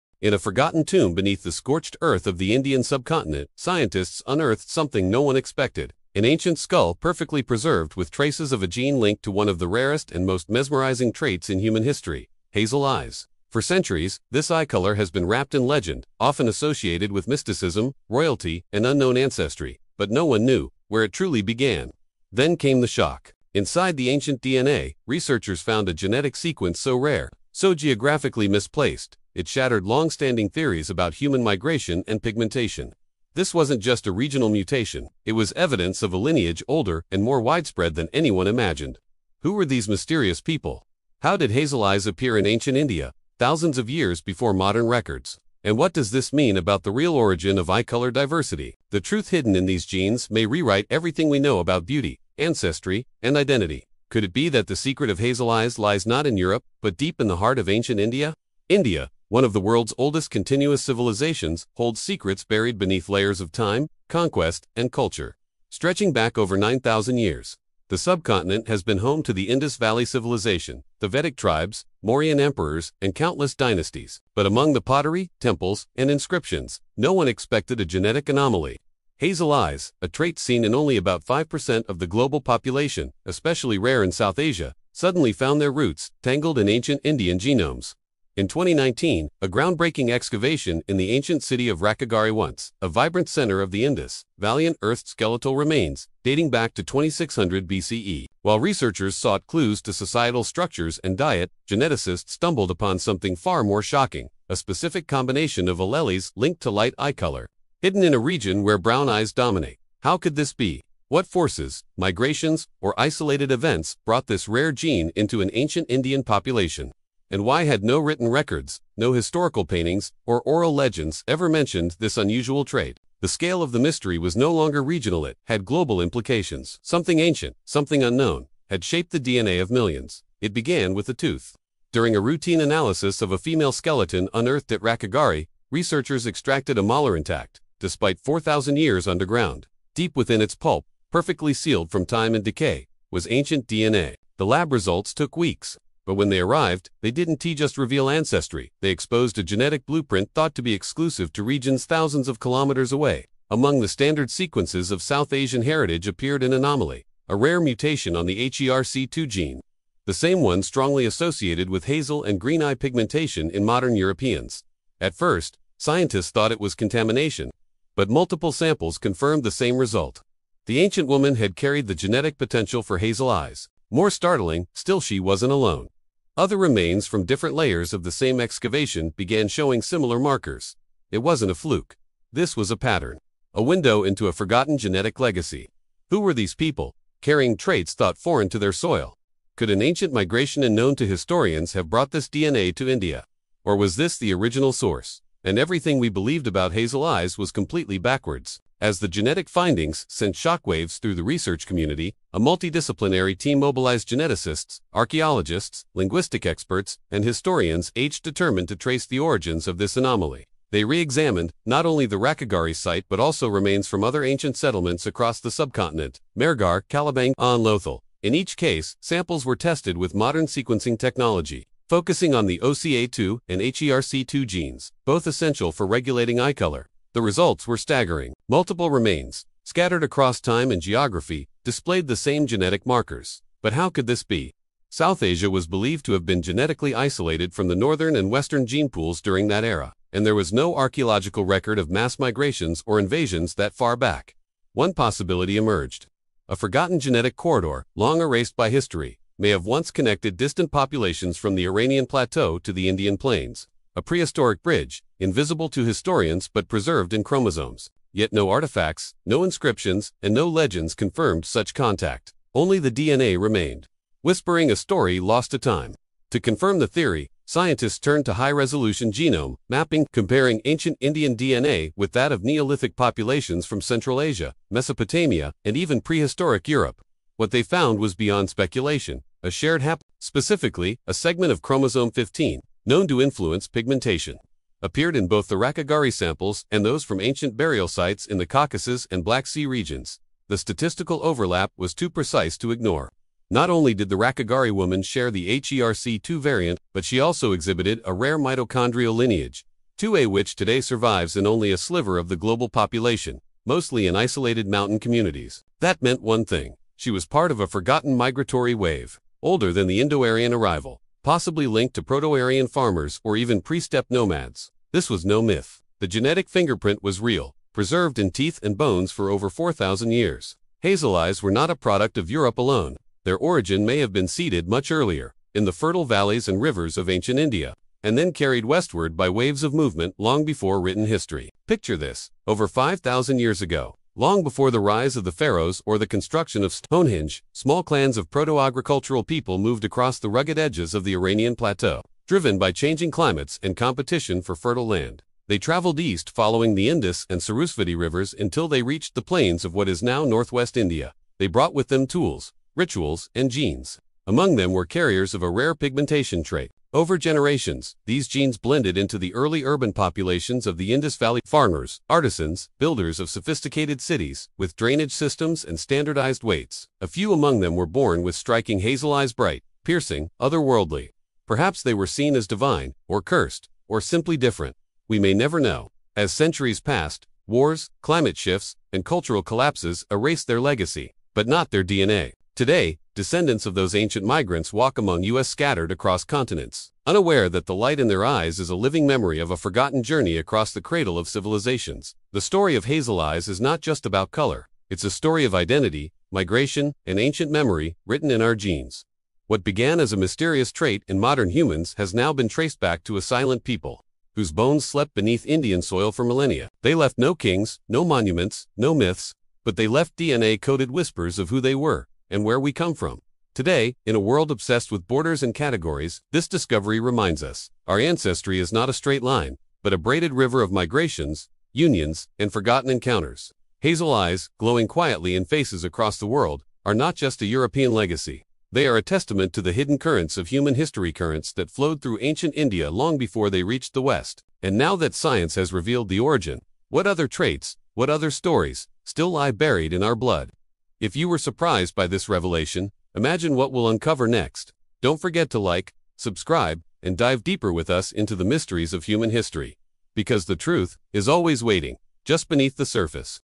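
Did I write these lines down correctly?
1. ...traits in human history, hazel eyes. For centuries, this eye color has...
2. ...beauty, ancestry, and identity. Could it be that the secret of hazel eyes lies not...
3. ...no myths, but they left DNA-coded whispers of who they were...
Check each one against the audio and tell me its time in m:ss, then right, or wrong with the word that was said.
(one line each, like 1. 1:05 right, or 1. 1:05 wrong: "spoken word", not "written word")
1. 0:11 right
2. 0:51 right
3. 6:48 right.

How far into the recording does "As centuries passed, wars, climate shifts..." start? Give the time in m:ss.
6:16.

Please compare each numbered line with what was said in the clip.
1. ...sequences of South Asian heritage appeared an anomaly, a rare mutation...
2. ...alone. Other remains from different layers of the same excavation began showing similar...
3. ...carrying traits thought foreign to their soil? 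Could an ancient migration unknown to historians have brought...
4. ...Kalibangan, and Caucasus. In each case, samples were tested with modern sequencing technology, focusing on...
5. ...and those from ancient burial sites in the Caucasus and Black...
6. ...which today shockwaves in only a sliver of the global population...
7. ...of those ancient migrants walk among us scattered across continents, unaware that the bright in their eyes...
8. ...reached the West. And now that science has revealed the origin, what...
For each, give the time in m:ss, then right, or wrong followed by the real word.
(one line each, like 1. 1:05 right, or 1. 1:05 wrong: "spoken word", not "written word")
1. 2:34 right
2. 2:55 right
3. 3:07 right
4. 3:36 wrong: "Lothal", not "Caucasus"
5. 4:46 right
6. 5:00 wrong: "survives", not "shockwaves"
7. 6:23 wrong: "light", not "bright"
8. 7:13 right.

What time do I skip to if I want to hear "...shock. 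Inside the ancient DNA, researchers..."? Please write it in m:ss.
0:22.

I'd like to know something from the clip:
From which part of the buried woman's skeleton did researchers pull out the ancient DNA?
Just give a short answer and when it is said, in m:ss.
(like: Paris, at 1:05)
A molar, at 2:16.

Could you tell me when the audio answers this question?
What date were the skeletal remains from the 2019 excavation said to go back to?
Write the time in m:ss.
1:36.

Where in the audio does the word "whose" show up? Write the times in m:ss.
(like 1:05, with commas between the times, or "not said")
6:44.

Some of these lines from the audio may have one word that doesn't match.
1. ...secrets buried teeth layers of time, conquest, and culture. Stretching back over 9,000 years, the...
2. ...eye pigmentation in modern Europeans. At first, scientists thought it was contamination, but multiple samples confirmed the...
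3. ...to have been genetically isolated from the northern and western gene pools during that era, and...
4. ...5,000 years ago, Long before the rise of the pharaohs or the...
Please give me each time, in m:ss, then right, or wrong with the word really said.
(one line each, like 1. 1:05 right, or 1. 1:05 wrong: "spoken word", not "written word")
1. 1:02 wrong: "beneath", not "teeth"
2. 2:42 right
3. 3:56 right
4. 5:32 right.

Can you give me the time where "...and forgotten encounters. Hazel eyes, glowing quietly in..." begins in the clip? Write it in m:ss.
7:02.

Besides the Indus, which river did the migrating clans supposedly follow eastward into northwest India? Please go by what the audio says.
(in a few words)
Sarasvati.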